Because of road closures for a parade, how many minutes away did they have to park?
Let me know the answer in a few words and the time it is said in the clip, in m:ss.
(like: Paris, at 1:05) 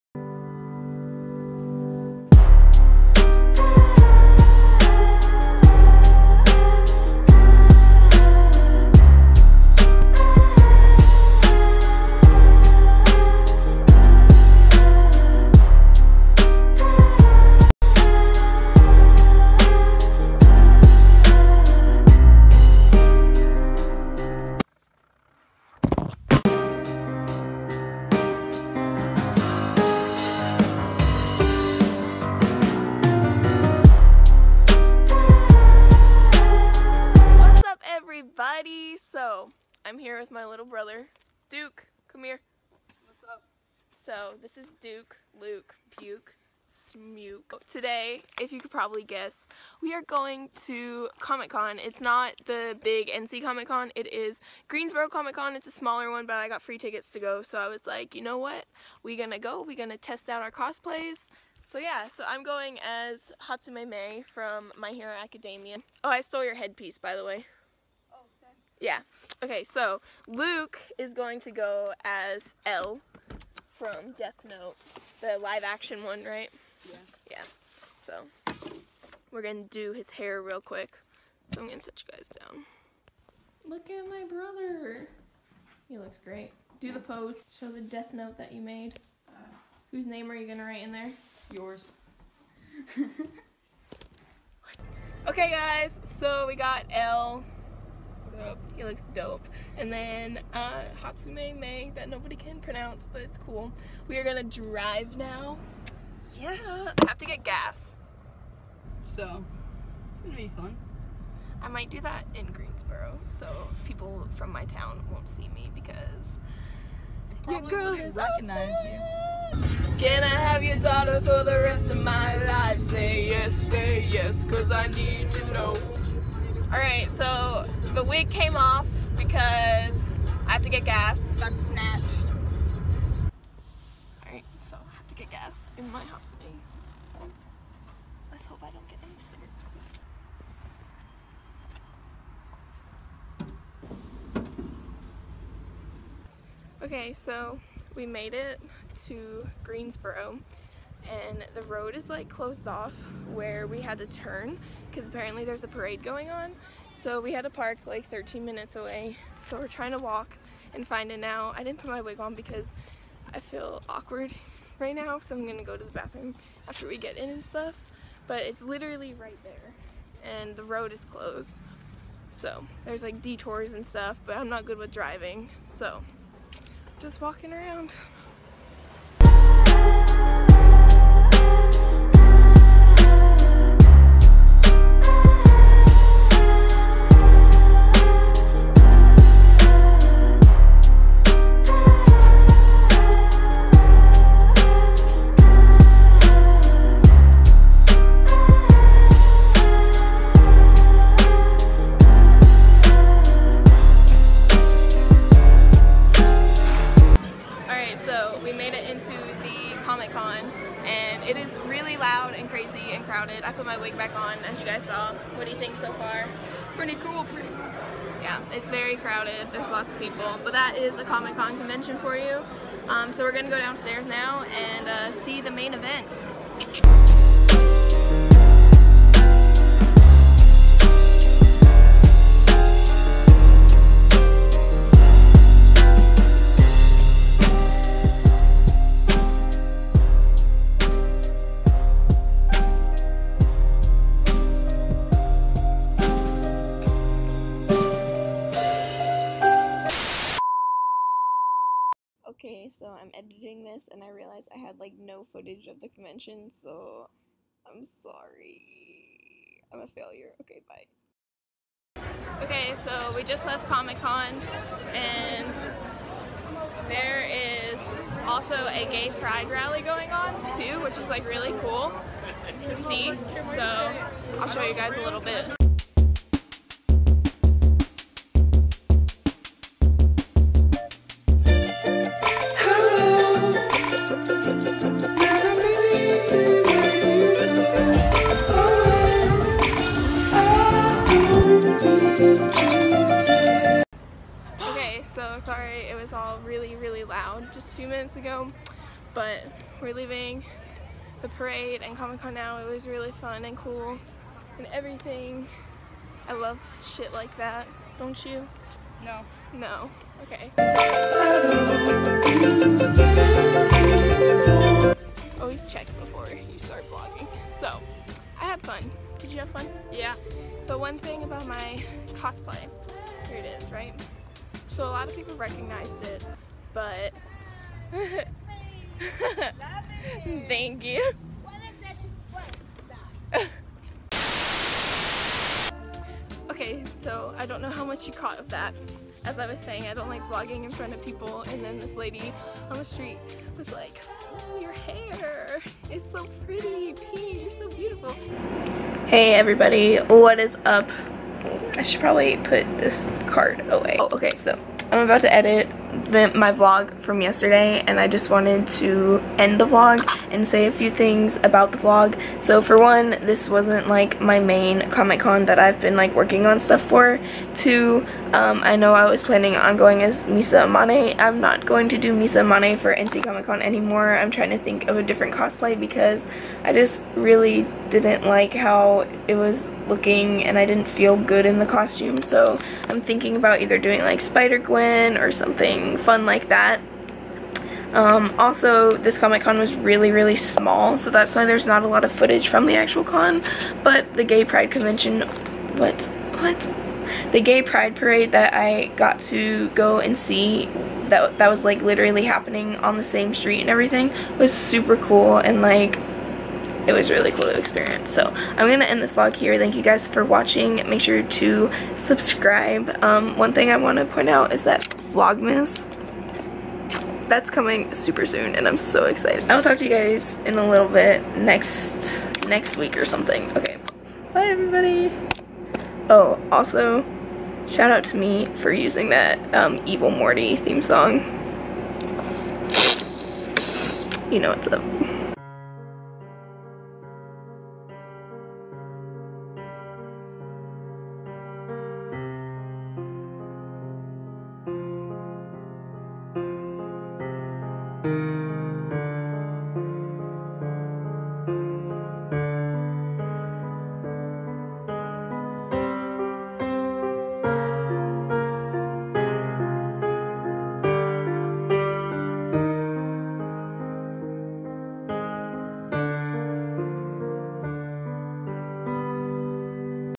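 13 minutes, at 2:38.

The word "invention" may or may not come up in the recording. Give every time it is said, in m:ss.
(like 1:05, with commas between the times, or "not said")
not said.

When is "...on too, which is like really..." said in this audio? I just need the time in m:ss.
4:30.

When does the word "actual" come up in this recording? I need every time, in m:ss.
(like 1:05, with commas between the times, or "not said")
6:32.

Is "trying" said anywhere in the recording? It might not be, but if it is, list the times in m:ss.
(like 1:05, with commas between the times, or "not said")
2:39, 6:14.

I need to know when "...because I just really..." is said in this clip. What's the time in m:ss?
6:15.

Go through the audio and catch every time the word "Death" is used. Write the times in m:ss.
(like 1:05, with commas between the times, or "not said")
1:14, 1:27.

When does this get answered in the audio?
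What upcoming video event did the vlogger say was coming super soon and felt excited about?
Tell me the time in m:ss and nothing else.
6:55.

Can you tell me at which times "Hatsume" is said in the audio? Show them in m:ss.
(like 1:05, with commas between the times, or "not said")
1:03, 1:41.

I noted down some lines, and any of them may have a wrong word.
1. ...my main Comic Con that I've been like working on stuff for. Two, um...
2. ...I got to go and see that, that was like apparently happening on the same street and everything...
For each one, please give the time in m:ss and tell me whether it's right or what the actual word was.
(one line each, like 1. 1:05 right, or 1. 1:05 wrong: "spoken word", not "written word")
1. 6:04 right
2. 6:38 wrong: "literally", not "apparently".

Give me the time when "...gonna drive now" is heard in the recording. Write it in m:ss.
1:44.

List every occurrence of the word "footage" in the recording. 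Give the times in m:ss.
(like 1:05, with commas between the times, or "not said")
4:15, 6:32.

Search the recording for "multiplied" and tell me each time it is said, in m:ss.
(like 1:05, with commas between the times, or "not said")
not said.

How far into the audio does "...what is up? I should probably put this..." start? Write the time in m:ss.
5:49.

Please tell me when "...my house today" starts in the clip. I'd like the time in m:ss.
2:15.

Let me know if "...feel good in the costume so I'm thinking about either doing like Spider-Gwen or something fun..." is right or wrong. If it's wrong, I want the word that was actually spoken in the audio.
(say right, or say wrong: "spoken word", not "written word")
right.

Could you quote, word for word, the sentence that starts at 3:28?
made it into the Comic Con and it is really loud and crazy and crowded.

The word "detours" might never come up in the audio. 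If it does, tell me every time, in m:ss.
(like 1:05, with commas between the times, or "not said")
2:53.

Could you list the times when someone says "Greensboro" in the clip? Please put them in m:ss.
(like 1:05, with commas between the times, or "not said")
0:54, 1:52, 2:29.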